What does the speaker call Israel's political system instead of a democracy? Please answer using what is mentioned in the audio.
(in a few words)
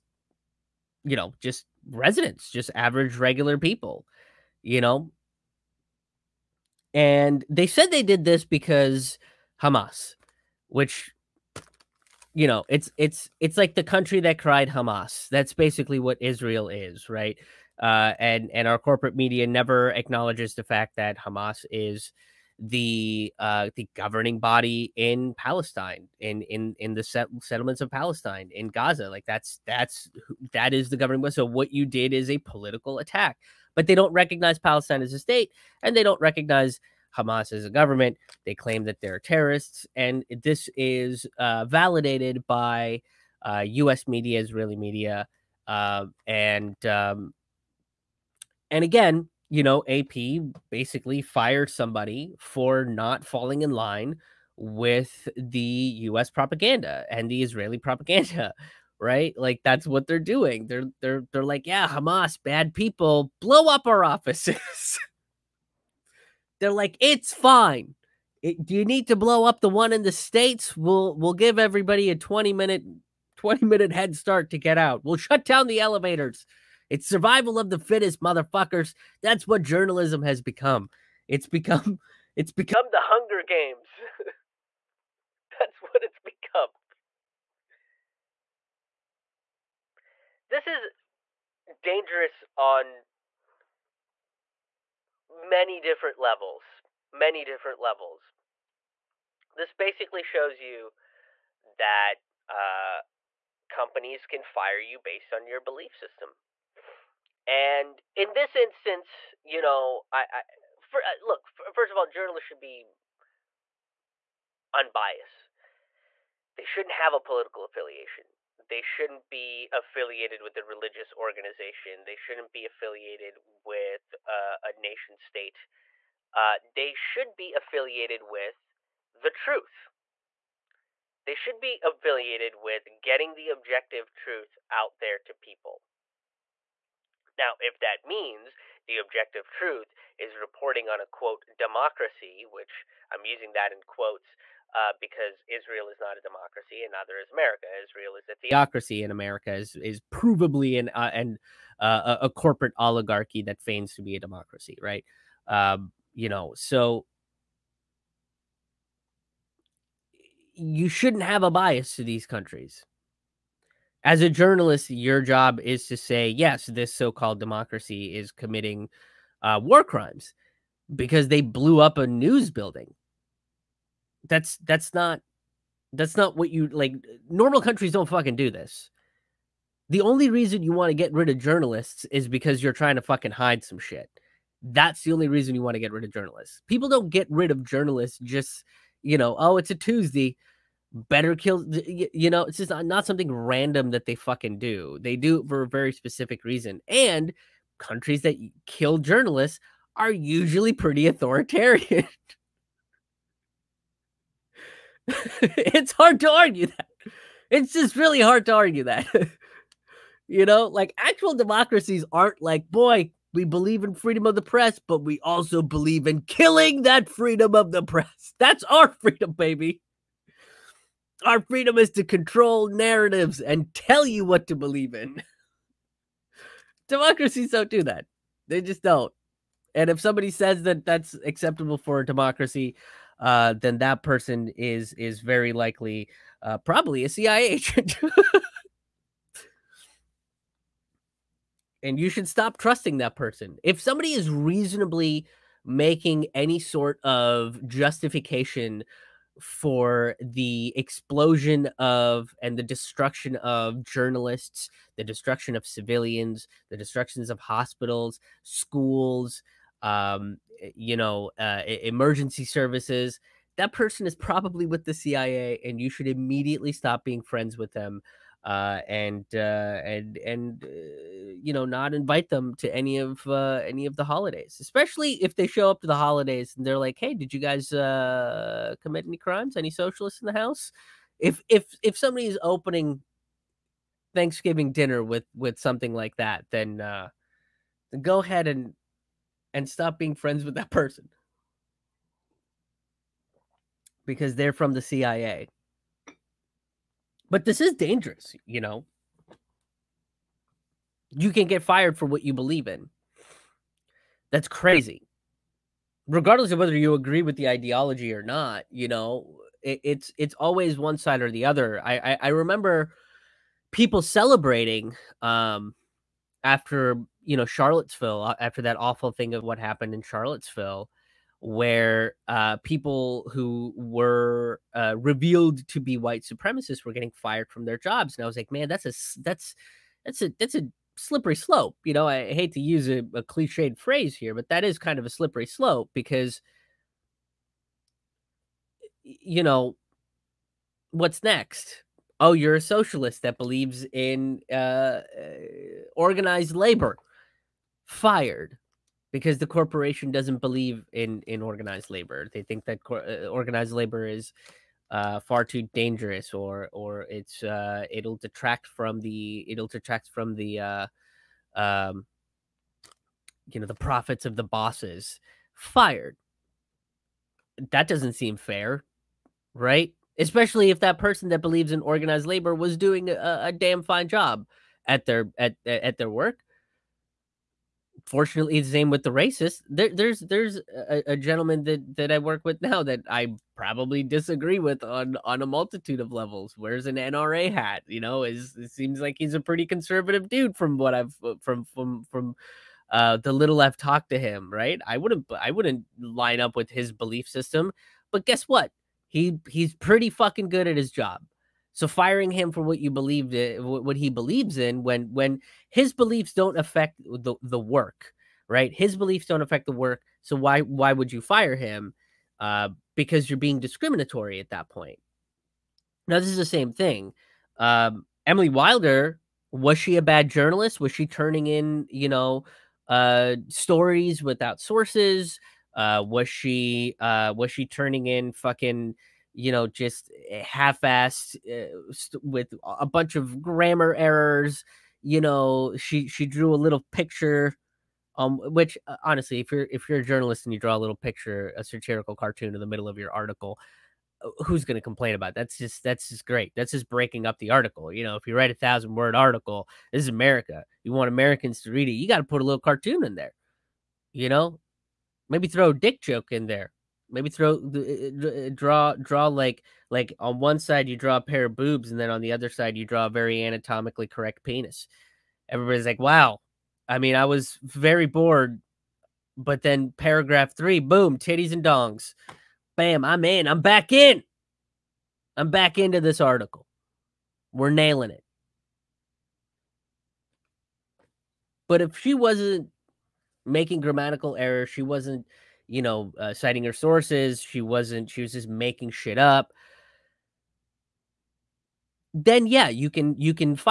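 Theocracy.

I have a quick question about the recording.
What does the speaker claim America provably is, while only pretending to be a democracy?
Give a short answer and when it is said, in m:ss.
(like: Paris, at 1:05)
Corporate oligarchy, at 2:32.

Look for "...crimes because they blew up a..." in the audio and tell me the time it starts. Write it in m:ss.
2:49.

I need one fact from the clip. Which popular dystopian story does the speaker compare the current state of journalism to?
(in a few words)
The Hunger Games.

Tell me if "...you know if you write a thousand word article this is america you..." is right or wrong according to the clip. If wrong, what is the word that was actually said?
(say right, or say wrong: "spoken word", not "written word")
right.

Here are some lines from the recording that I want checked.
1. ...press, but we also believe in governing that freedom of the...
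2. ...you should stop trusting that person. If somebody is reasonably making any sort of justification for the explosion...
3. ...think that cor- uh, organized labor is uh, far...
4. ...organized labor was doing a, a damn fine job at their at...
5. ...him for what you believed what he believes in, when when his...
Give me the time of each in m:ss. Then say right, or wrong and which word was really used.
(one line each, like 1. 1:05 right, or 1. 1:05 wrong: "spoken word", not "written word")
1. 3:34 wrong: "killing", not "governing"
2. 4:02 right
3. 5:52 right
4. 6:11 right
5. 6:42 right.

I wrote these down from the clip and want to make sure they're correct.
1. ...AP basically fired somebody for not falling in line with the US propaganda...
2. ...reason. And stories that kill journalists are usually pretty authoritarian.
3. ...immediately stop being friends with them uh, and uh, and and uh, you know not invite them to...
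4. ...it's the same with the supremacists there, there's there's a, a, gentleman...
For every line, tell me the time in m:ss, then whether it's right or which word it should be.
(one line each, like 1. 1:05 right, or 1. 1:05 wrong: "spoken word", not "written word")
1. 0:49 right
2. 3:16 wrong: "countries", not "stories"
3. 4:26 right
4. 6:18 wrong: "racists", not "supremacists".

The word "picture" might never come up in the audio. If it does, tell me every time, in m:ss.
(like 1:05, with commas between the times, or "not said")
7:16, 7:20.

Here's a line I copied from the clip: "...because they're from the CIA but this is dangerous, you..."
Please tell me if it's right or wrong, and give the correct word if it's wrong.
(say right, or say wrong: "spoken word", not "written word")
right.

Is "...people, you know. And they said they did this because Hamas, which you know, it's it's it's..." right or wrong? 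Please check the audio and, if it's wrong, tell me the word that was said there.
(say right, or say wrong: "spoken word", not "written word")
right.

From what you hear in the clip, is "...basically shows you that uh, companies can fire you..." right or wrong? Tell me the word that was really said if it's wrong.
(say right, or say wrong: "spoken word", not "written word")
right.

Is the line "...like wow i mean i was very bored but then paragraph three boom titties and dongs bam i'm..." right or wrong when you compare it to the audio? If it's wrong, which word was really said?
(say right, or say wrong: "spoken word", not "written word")
right.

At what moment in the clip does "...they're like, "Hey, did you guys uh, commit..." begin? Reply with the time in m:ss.
4:36.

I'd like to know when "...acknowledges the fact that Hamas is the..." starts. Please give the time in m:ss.
0:19.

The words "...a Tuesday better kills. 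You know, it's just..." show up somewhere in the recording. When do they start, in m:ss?
3:09.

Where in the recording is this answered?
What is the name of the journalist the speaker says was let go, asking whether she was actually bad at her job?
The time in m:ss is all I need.
6:58.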